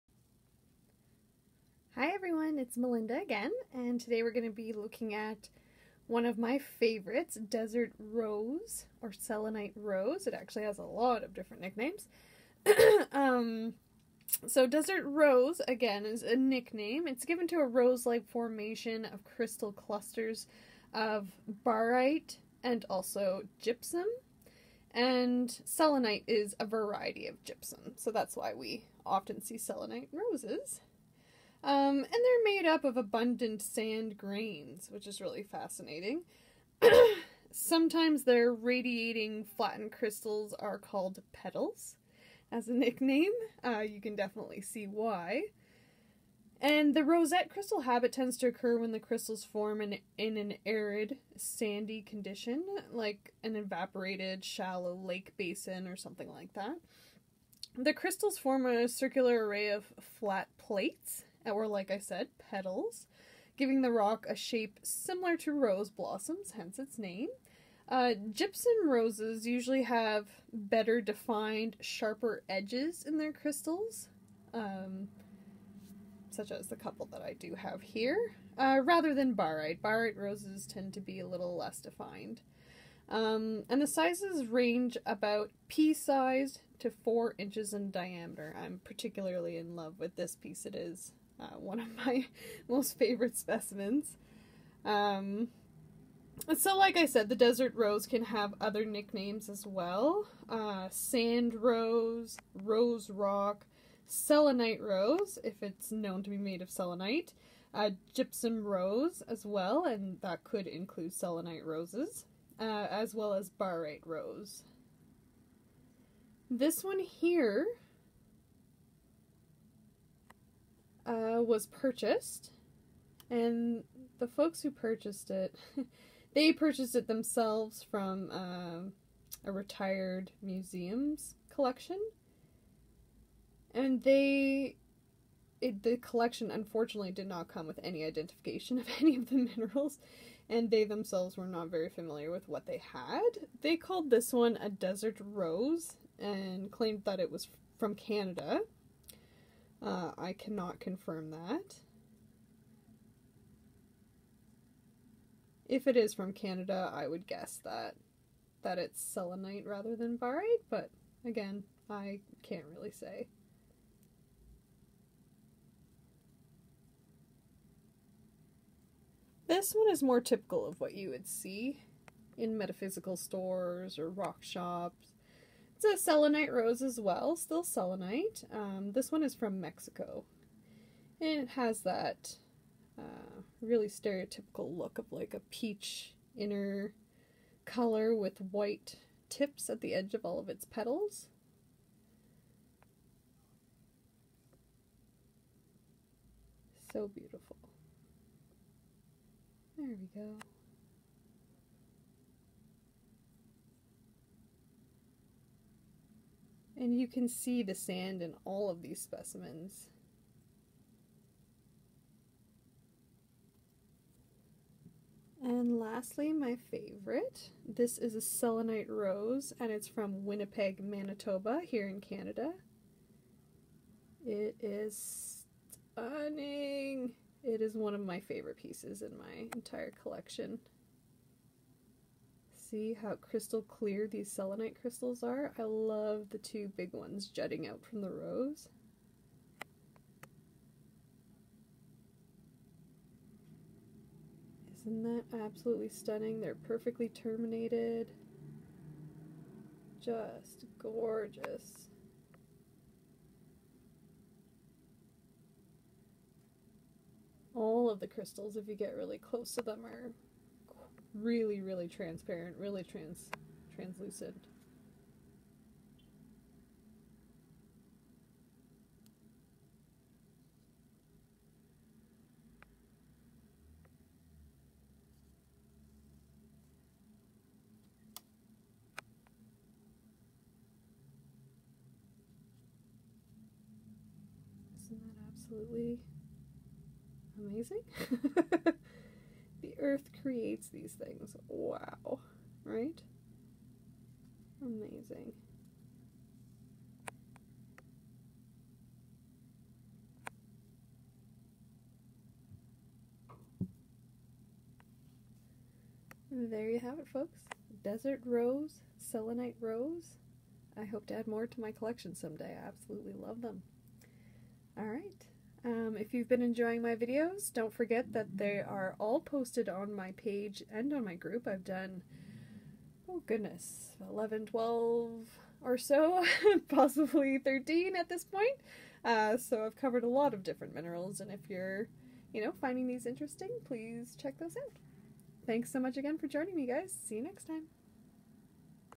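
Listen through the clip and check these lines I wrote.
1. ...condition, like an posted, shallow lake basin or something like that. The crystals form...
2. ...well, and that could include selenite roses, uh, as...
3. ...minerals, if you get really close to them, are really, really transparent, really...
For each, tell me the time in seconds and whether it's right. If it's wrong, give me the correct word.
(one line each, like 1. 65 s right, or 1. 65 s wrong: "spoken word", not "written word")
1. 52 s wrong: "evaporated", not "posted"
2. 109 s right
3. 258 s wrong: "crystals", not "minerals".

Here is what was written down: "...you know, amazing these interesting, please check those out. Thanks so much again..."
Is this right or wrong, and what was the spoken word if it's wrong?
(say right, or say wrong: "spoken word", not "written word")
wrong: "finding", not "amazing".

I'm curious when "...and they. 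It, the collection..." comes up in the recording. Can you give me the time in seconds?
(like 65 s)
133 s.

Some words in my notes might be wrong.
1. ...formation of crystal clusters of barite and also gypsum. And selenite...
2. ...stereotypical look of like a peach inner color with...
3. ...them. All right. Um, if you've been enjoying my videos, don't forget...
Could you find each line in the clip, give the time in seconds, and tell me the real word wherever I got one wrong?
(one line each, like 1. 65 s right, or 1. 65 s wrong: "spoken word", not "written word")
1. 18 s right
2. 183 s right
3. 313 s right.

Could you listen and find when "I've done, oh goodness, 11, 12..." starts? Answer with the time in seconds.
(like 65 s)
321 s.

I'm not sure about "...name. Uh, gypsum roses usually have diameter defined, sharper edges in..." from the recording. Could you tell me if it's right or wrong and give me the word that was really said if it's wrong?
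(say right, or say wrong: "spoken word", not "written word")
wrong: "better", not "diameter".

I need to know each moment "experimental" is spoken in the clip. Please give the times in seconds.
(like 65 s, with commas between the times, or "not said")
not said.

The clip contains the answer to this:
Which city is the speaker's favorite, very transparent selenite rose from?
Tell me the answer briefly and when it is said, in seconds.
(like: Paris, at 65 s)
Winnipeg, Manitoba, at 220 s.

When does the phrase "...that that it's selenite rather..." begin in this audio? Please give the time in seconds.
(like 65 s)
157 s.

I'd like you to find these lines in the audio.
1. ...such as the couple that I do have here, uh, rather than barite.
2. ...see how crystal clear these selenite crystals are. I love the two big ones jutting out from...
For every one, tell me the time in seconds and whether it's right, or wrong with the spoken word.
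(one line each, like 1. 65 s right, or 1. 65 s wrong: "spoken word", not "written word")
1. 76 s right
2. 232 s right.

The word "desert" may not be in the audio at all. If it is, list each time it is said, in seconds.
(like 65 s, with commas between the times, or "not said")
7 s, 14 s, 97 s, 144 s, 307 s.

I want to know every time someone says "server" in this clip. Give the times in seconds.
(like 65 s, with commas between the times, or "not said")
not said.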